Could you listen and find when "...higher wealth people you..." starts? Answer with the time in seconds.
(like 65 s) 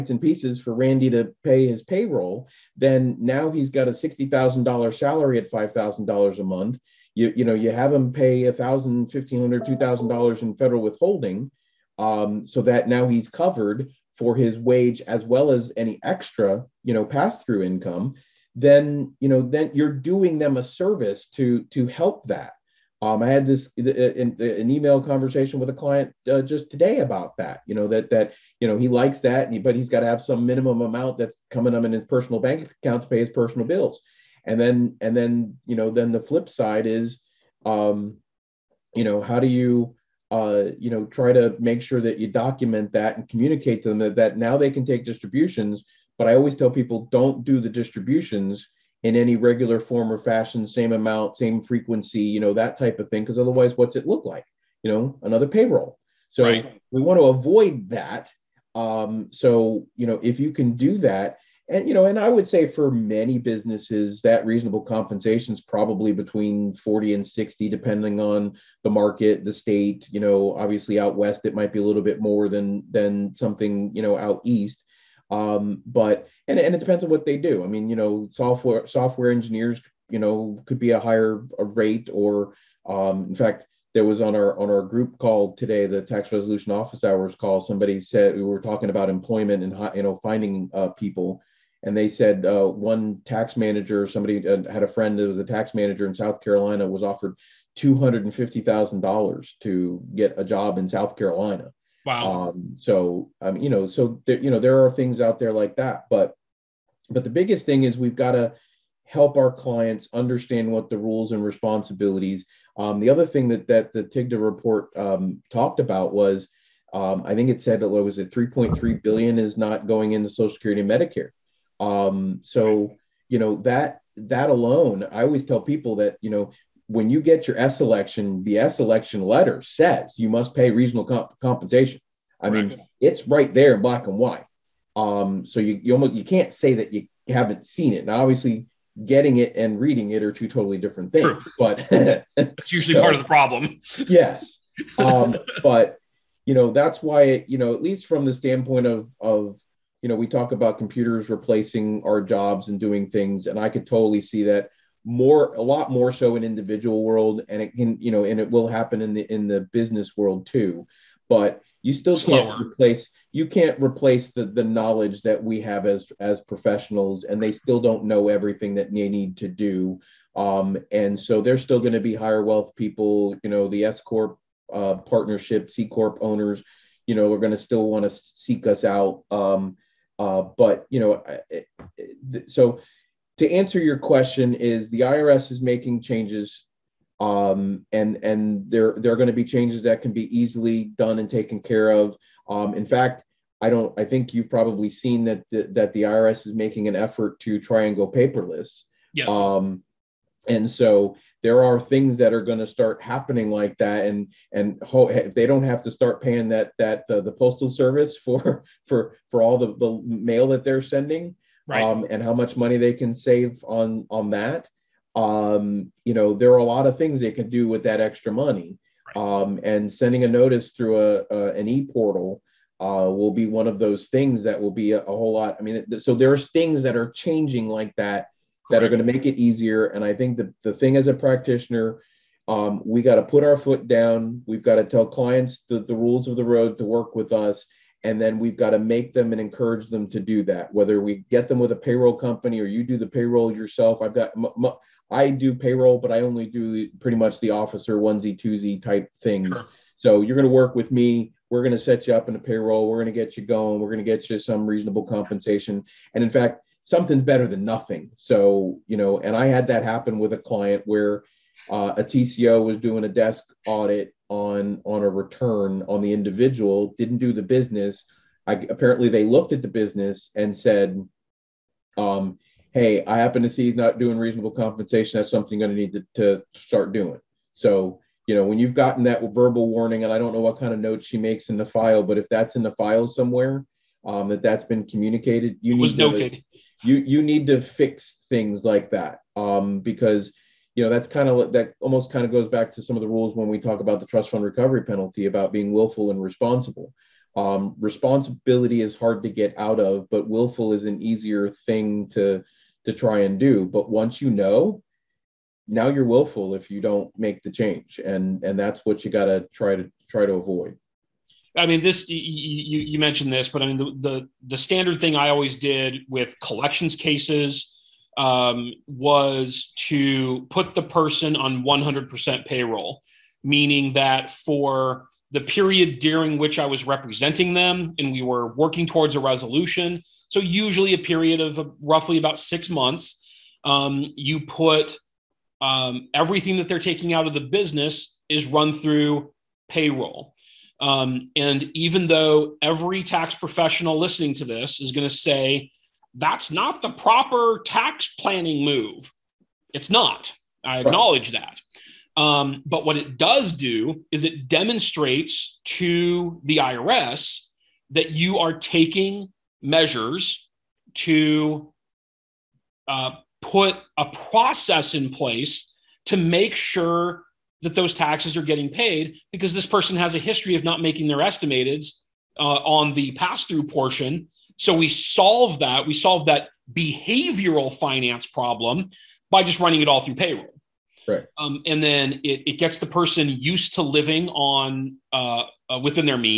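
172 s.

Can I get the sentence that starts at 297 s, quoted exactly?
Um, responsibility is hard to get out of, but willful is an easier thing to to try and do.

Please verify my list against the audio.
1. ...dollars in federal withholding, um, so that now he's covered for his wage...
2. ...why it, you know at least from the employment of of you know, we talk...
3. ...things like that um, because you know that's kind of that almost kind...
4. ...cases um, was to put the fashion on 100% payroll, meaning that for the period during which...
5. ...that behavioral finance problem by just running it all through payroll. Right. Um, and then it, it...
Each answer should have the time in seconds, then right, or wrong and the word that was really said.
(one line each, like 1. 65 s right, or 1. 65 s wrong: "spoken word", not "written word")
1. 10 s right
2. 147 s wrong: "standpoint", not "employment"
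3. 288 s right
4. 316 s wrong: "person", not "fashion"
5. 376 s right.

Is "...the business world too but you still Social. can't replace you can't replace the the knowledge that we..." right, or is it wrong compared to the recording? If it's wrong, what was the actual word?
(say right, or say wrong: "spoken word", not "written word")
wrong: "Slower", not "Social".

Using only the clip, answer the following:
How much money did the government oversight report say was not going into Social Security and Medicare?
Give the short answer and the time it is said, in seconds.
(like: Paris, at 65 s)
3.3 billion, at 118 s.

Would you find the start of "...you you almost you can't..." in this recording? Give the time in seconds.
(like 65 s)
135 s.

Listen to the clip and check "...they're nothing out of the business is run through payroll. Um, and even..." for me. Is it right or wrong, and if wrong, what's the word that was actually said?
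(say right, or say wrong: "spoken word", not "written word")
wrong: "taking", not "nothing".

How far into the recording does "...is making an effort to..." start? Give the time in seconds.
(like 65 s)
196 s.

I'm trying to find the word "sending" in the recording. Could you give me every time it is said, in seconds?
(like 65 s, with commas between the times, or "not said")
210 s, 219 s.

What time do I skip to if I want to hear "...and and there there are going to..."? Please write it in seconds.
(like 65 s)
187 s.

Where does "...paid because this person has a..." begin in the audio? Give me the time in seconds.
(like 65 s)
368 s.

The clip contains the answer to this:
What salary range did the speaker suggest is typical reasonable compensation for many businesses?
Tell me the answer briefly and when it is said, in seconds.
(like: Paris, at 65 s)
40 and 60, at 66 s.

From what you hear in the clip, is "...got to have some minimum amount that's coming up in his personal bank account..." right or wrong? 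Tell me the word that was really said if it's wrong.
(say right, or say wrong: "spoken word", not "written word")
right.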